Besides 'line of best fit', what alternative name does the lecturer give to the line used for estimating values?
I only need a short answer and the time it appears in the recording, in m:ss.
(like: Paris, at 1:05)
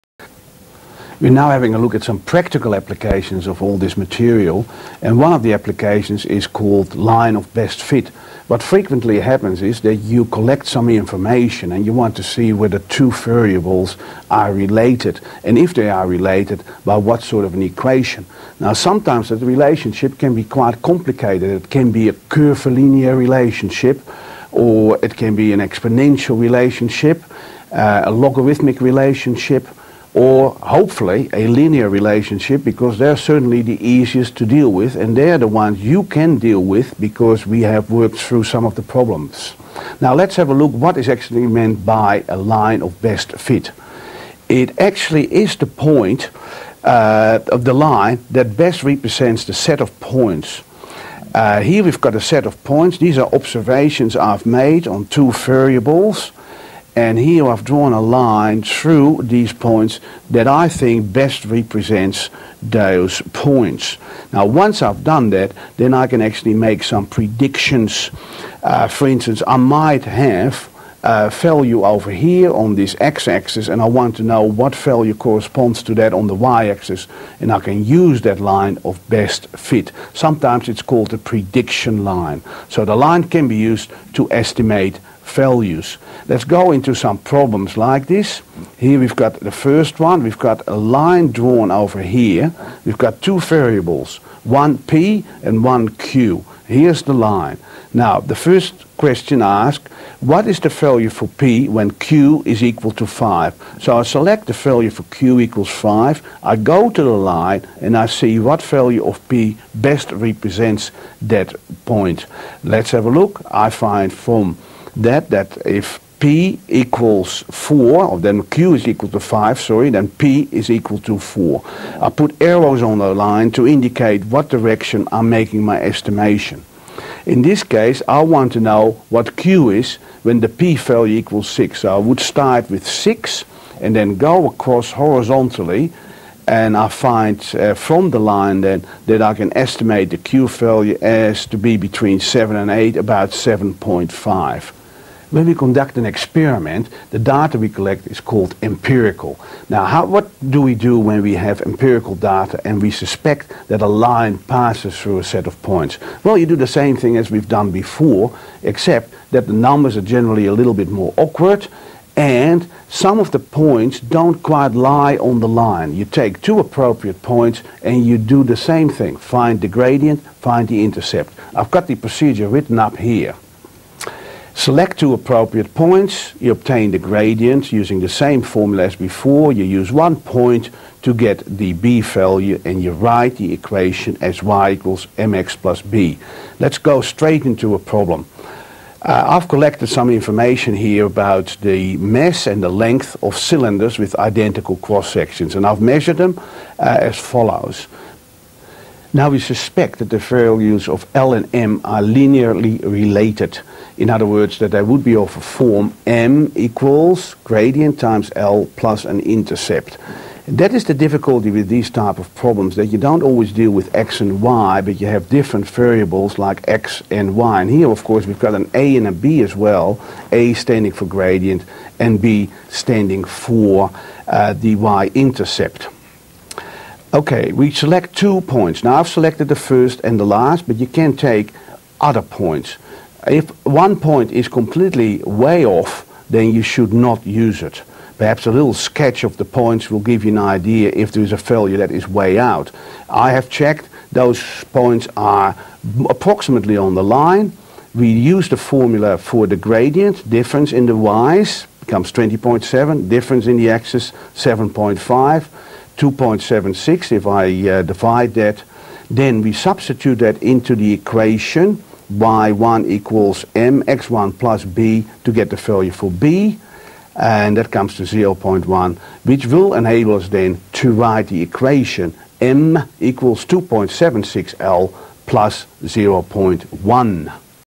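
prediction line, at 1:21.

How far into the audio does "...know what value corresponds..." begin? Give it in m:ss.
1:14.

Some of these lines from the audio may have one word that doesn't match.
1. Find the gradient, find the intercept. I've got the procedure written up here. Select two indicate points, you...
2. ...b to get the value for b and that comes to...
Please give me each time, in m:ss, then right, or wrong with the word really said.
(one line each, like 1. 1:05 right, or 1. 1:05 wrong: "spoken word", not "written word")
1. 2:49 wrong: "appropriate", not "indicate"
2. 4:24 right.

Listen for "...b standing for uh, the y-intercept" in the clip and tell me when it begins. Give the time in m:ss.
3:42.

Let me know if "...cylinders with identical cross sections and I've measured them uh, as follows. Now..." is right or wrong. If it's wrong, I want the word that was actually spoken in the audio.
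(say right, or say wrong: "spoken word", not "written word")
right.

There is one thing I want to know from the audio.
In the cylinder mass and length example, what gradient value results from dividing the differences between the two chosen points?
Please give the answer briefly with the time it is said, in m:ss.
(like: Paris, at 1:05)
2.76, at 4:16.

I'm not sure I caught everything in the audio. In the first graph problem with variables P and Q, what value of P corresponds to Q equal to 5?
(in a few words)
4.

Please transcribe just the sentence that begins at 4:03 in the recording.
I have checked, those points are approximately on the line.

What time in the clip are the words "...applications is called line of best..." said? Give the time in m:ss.
0:05.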